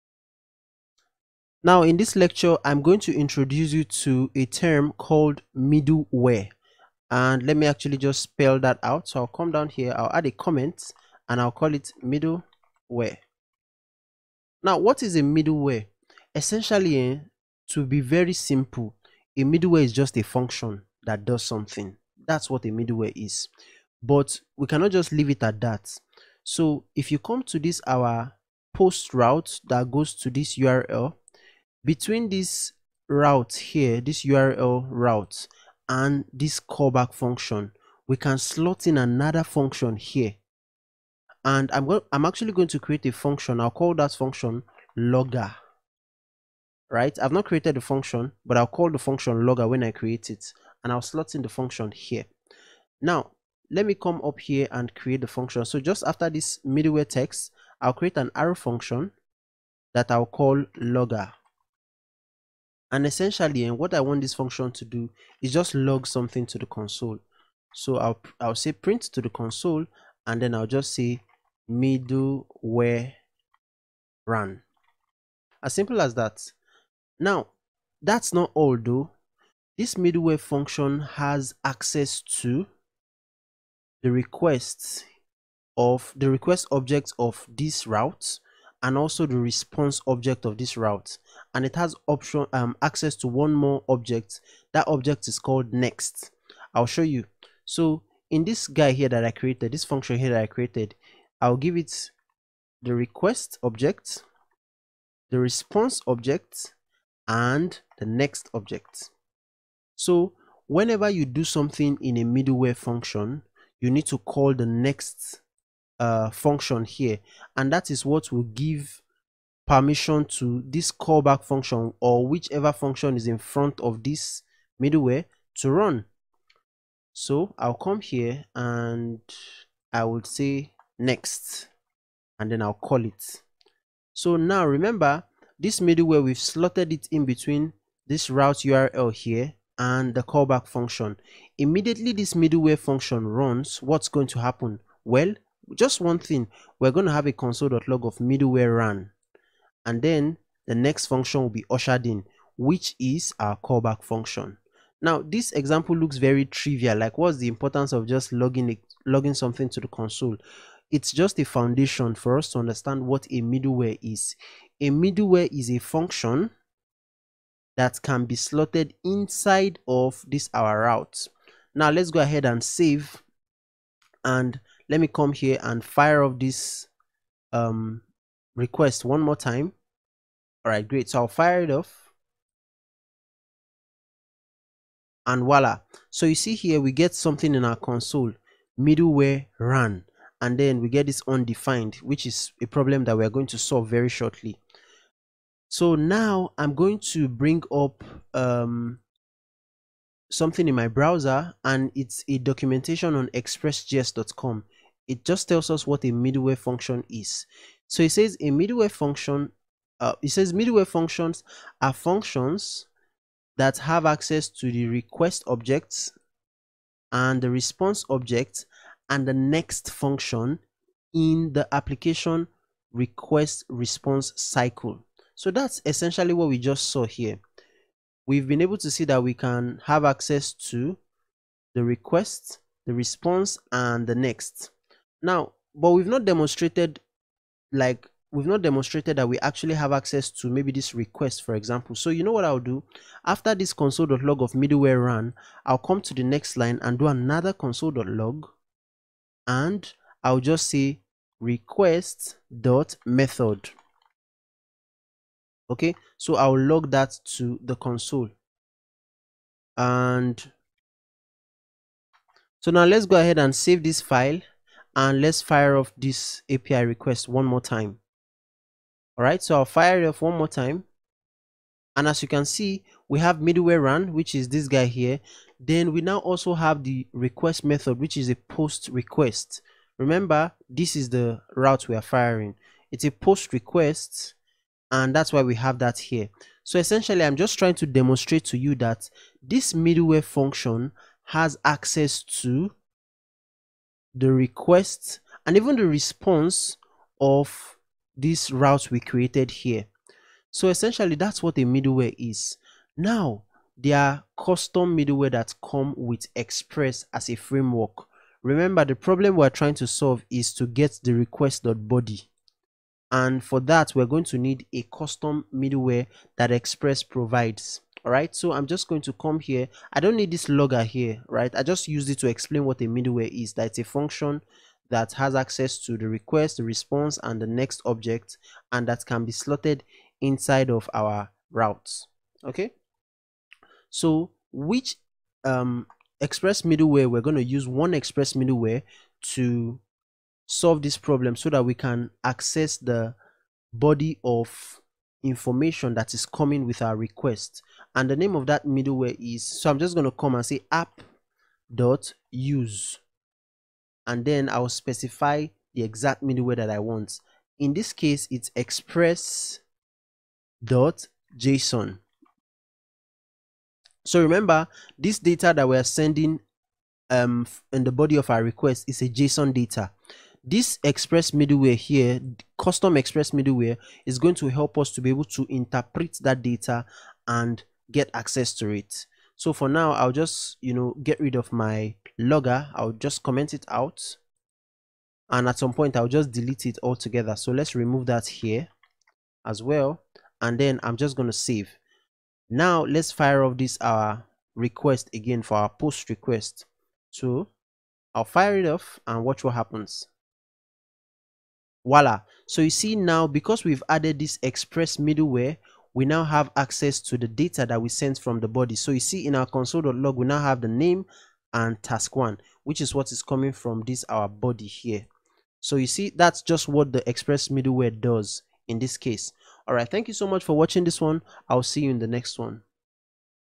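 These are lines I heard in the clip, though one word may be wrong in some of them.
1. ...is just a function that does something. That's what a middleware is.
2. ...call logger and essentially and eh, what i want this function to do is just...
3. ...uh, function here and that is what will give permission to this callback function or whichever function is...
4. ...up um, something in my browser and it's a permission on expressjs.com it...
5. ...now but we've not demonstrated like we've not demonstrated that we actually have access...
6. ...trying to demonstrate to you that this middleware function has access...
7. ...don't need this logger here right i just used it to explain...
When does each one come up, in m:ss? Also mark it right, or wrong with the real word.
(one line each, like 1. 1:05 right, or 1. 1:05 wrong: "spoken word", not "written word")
1. 0:19 right
2. 1:00 right
3. 1:56 right
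4. 3:17 wrong: "documentation", not "permission"
5. 3:55 right
6. 4:47 right
7. 5:19 right.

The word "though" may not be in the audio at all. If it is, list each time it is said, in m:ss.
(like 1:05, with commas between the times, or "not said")
1:18.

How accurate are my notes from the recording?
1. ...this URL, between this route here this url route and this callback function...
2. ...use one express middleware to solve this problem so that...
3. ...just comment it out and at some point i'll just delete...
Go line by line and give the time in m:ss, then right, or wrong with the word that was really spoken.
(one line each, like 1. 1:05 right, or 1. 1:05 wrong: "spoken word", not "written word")
1. 0:30 right
2. 5:37 right
3. 6:22 right.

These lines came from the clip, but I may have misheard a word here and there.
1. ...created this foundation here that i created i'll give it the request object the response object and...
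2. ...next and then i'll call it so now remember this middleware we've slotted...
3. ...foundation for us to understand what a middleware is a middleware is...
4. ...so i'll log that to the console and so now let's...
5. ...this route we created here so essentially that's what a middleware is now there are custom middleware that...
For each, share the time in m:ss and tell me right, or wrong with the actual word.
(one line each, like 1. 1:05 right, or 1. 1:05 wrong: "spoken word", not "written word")
1. 1:39 wrong: "function", not "foundation"
2. 2:10 right
3. 2:41 right
4. 4:16 right
5. 4:58 right.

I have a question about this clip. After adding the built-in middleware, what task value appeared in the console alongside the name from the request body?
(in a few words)
task one.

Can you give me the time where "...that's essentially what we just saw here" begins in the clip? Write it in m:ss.
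3:45.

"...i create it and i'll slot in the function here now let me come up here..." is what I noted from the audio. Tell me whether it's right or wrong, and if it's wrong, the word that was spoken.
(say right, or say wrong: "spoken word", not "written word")
right.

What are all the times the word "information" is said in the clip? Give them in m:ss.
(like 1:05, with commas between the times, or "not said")
5:45.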